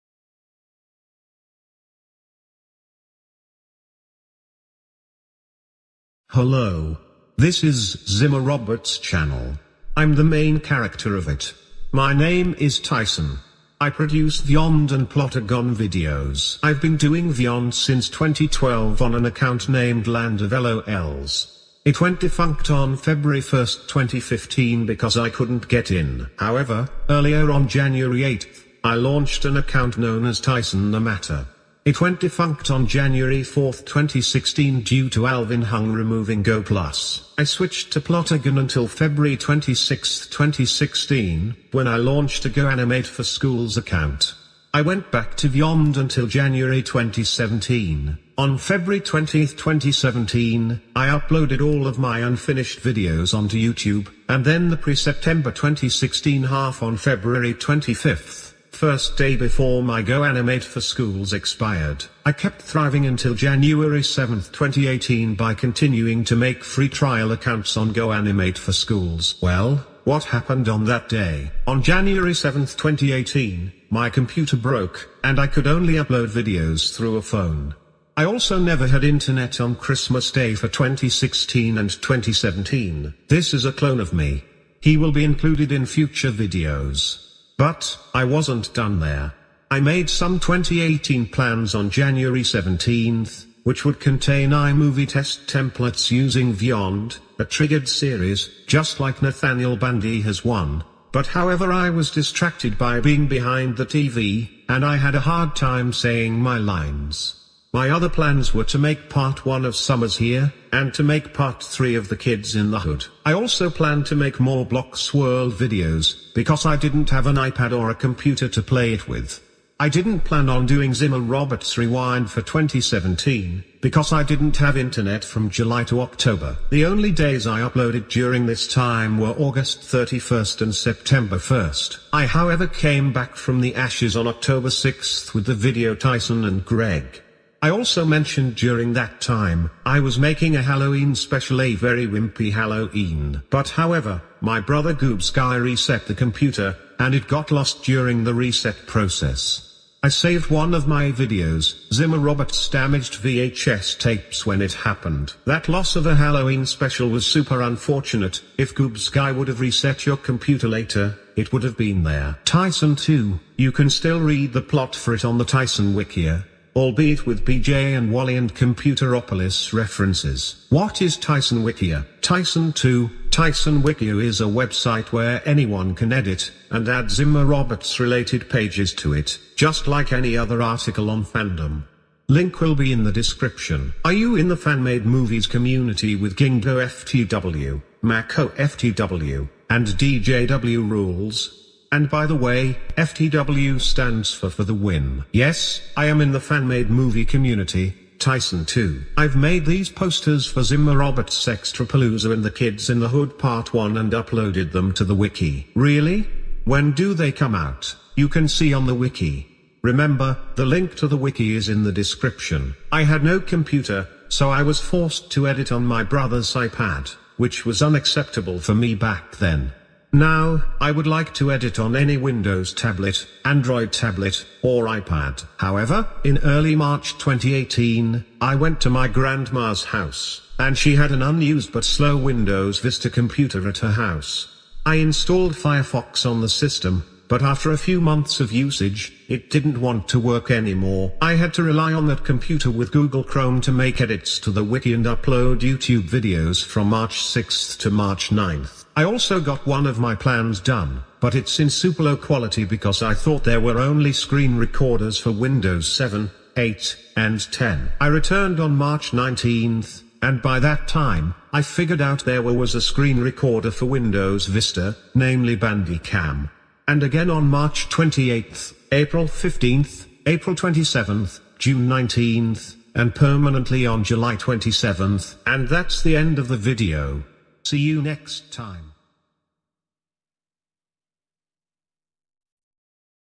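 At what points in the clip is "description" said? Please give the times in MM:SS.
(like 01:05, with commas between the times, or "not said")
03:03, 03:31.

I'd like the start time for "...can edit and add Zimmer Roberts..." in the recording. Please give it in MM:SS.
02:55.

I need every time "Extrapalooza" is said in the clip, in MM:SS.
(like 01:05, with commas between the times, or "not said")
03:21.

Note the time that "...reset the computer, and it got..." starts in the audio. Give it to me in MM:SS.
02:25.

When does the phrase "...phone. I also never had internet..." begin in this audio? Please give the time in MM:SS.
01:17.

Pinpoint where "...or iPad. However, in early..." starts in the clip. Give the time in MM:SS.
03:44.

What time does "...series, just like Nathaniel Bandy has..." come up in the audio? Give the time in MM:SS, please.
01:37.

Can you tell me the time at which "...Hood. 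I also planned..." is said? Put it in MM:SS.
01:52.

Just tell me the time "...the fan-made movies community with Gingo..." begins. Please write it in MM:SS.
03:04.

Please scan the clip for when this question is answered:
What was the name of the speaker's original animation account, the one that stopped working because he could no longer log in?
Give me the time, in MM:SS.
00:20.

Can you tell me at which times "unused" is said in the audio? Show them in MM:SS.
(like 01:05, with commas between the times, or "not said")
03:51.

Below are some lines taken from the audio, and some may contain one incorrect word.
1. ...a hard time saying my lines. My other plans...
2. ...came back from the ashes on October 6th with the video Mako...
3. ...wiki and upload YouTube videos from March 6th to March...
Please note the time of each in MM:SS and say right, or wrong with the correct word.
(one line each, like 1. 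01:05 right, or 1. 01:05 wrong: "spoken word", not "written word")
1. 01:45 right
2. 02:12 wrong: "Tyson", not "Mako"
3. 04:04 right.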